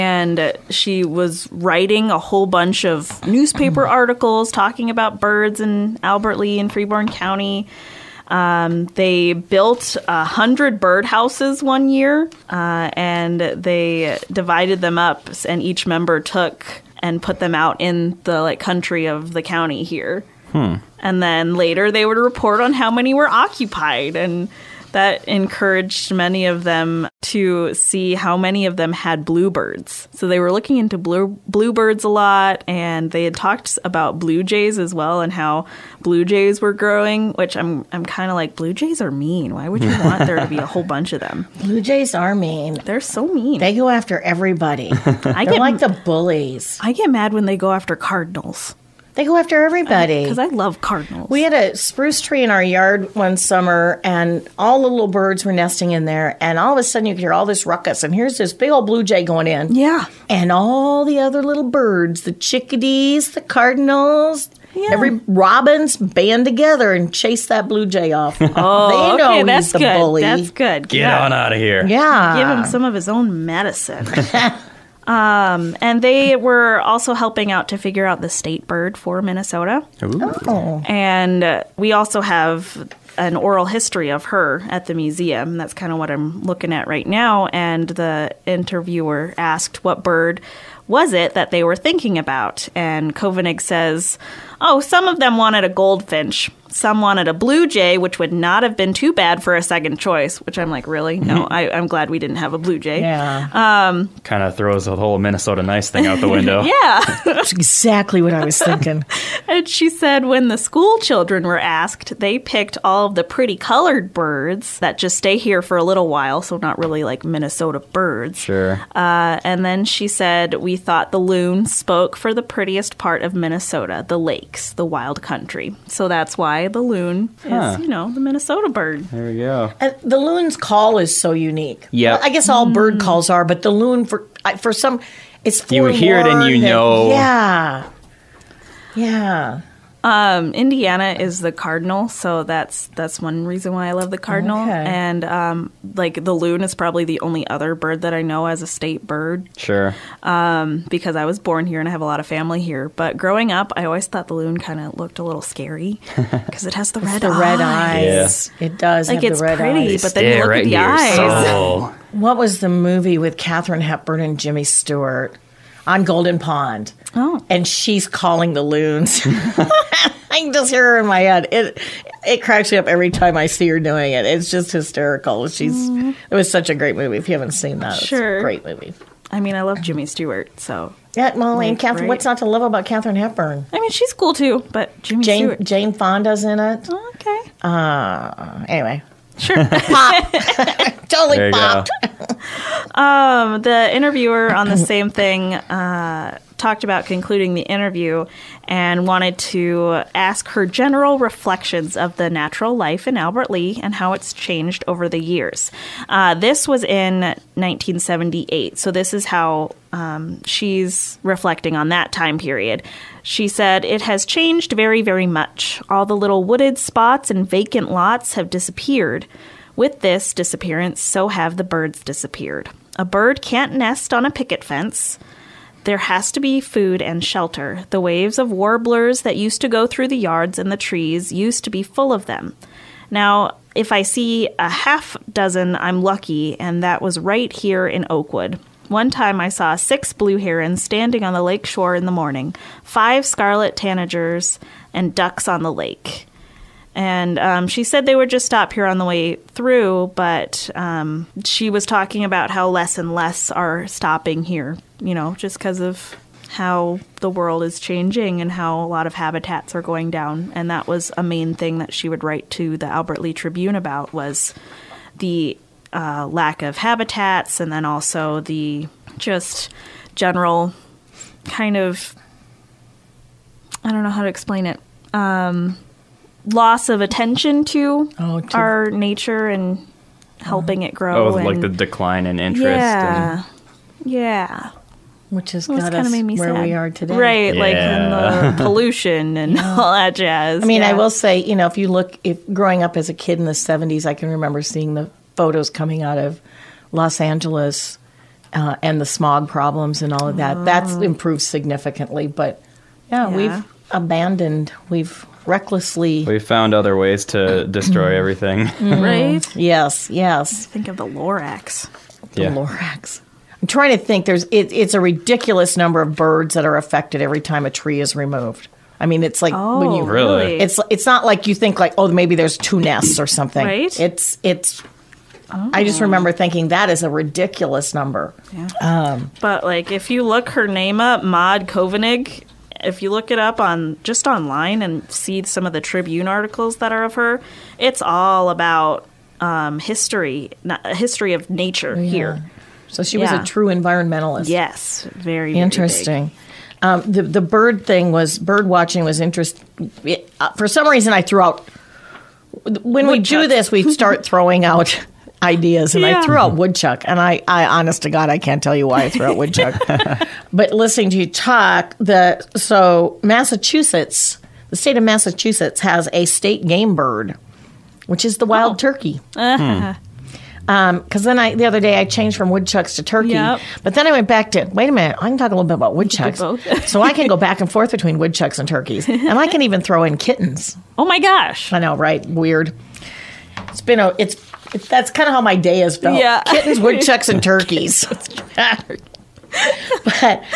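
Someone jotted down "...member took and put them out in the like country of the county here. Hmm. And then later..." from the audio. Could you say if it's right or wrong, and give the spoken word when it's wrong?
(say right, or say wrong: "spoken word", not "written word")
right.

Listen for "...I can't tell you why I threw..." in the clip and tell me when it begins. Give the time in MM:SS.
05:58.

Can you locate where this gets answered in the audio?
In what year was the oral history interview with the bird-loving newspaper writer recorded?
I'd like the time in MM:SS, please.
03:27.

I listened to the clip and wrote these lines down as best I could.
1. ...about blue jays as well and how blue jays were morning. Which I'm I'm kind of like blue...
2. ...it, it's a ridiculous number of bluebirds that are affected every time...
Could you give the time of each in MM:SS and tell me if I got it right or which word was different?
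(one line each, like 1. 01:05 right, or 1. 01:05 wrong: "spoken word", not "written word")
1. 00:33 wrong: "growing", not "morning"
2. 05:14 wrong: "birds", not "bluebirds".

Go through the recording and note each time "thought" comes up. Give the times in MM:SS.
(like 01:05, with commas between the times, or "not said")
02:00, 02:34.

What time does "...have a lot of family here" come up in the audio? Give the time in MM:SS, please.
02:31.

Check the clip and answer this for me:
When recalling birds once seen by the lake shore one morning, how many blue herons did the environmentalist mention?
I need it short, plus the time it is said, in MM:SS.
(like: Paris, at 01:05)
6, at 03:59.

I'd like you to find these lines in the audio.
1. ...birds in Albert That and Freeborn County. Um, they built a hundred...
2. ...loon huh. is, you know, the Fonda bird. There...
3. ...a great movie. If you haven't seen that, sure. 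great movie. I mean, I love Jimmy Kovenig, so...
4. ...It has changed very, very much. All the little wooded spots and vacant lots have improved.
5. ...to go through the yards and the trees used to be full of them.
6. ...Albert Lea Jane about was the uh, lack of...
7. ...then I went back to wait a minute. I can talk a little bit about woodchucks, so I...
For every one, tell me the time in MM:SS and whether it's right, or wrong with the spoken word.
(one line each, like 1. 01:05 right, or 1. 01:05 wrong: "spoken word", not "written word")
1. 00:05 wrong: "Lea", not "That"
2. 02:06 wrong: "Minnesota", not "Fonda"
3. 02:56 wrong: "Stewart", not "Kovenig"
4. 03:33 wrong: "disappeared", not "improved"
5. 03:49 right
6. 04:22 wrong: "Tribune", not "Jane"
7. 06:13 right.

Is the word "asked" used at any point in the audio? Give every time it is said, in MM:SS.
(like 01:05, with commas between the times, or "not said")
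01:29, 01:51.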